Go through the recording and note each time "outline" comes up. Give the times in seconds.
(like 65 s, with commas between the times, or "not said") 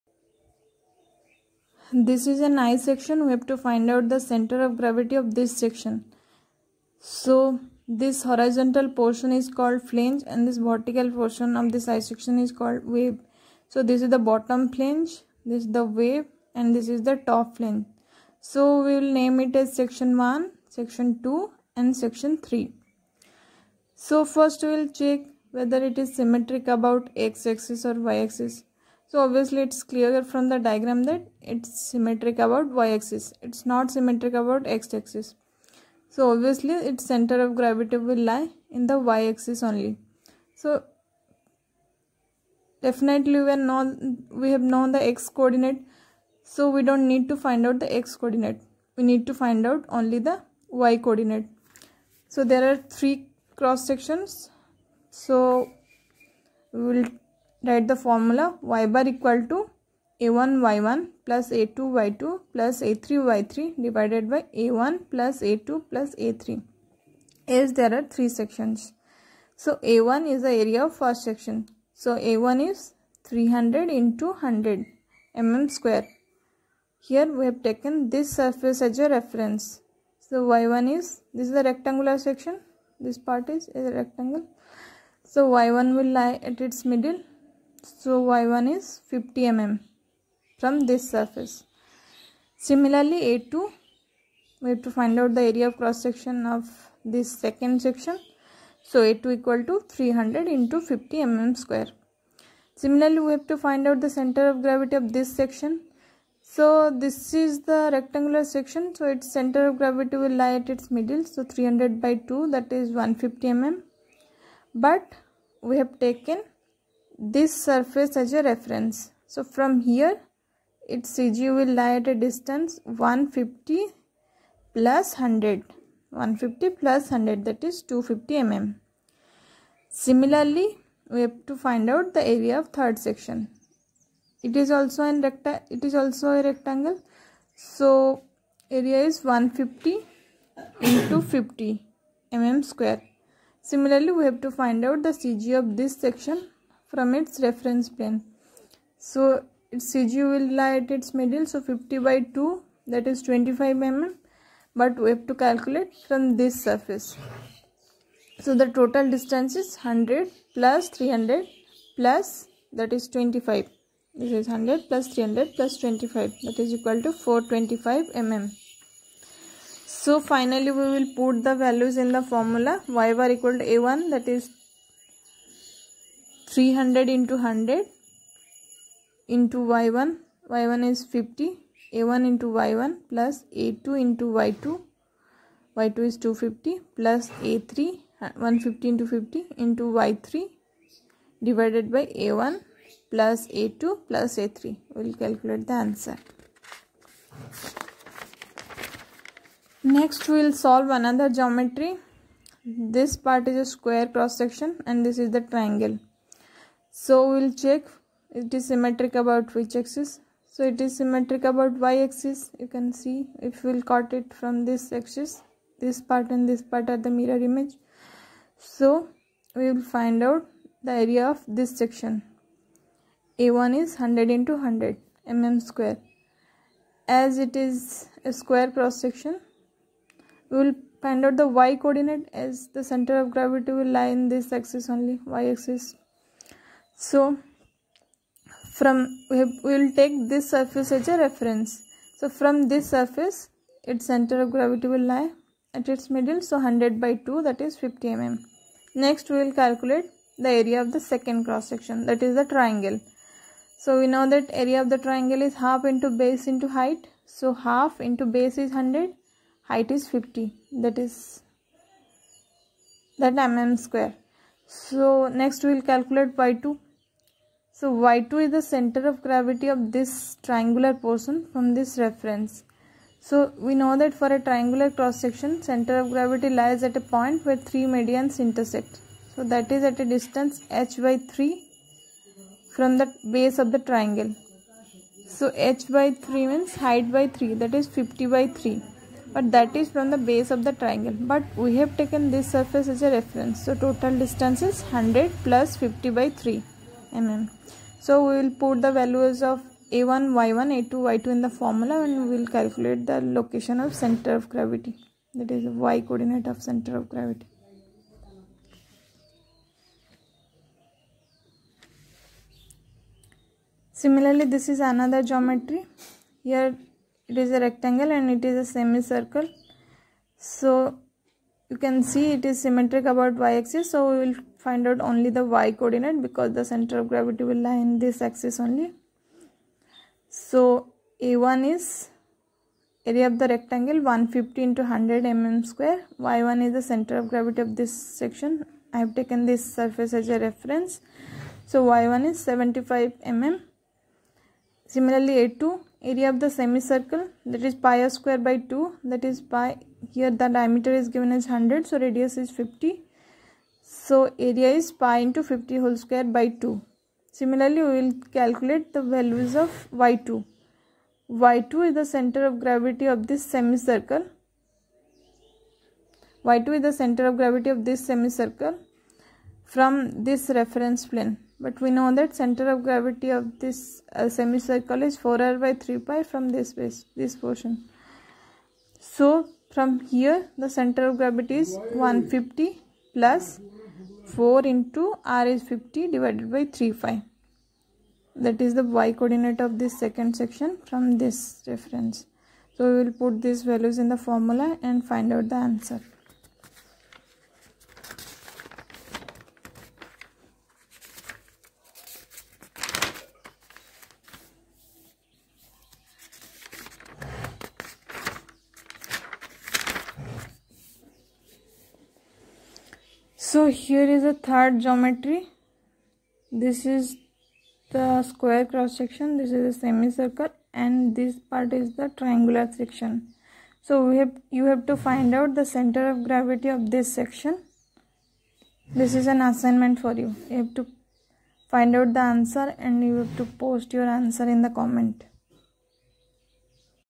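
not said.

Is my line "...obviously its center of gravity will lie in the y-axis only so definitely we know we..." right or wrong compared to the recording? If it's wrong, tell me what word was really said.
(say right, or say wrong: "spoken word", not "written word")
right.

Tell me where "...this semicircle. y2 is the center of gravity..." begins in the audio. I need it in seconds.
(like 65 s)
363 s.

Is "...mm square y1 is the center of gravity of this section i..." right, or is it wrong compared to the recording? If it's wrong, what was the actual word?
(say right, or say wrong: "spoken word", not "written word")
right.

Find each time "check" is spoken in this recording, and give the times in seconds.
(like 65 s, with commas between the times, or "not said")
24 s, 207 s.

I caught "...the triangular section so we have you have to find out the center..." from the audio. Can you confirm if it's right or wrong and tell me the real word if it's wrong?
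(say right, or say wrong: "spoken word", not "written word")
right.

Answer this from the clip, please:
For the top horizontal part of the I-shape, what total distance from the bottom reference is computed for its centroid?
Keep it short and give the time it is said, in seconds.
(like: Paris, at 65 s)
425 mm, at 167 s.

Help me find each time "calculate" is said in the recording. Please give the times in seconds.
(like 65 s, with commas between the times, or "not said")
155 s, 195 s, 249 s, 265 s, 302 s, 358 s.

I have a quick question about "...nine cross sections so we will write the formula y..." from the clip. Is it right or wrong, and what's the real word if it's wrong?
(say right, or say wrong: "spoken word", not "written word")
wrong: "three", not "nine".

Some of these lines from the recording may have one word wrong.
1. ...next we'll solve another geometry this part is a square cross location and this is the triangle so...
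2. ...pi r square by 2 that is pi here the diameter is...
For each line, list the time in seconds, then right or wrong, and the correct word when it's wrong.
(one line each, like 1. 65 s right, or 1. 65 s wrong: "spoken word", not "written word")
1. 199 s wrong: "section", not "location"
2. 347 s right.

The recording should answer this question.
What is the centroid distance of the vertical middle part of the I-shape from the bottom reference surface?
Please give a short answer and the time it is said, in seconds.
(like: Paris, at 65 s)
250 mm, at 127 s.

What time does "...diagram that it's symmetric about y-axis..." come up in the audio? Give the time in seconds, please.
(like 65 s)
30 s.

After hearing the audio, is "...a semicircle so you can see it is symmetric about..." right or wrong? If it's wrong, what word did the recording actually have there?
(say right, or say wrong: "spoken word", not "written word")
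right.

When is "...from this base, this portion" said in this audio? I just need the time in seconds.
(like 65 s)
376 s.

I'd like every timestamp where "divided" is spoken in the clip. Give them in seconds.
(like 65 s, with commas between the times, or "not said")
63 s, 191 s, 386 s.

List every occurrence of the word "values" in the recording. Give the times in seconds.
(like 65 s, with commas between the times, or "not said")
171 s, 298 s, 359 s, 393 s.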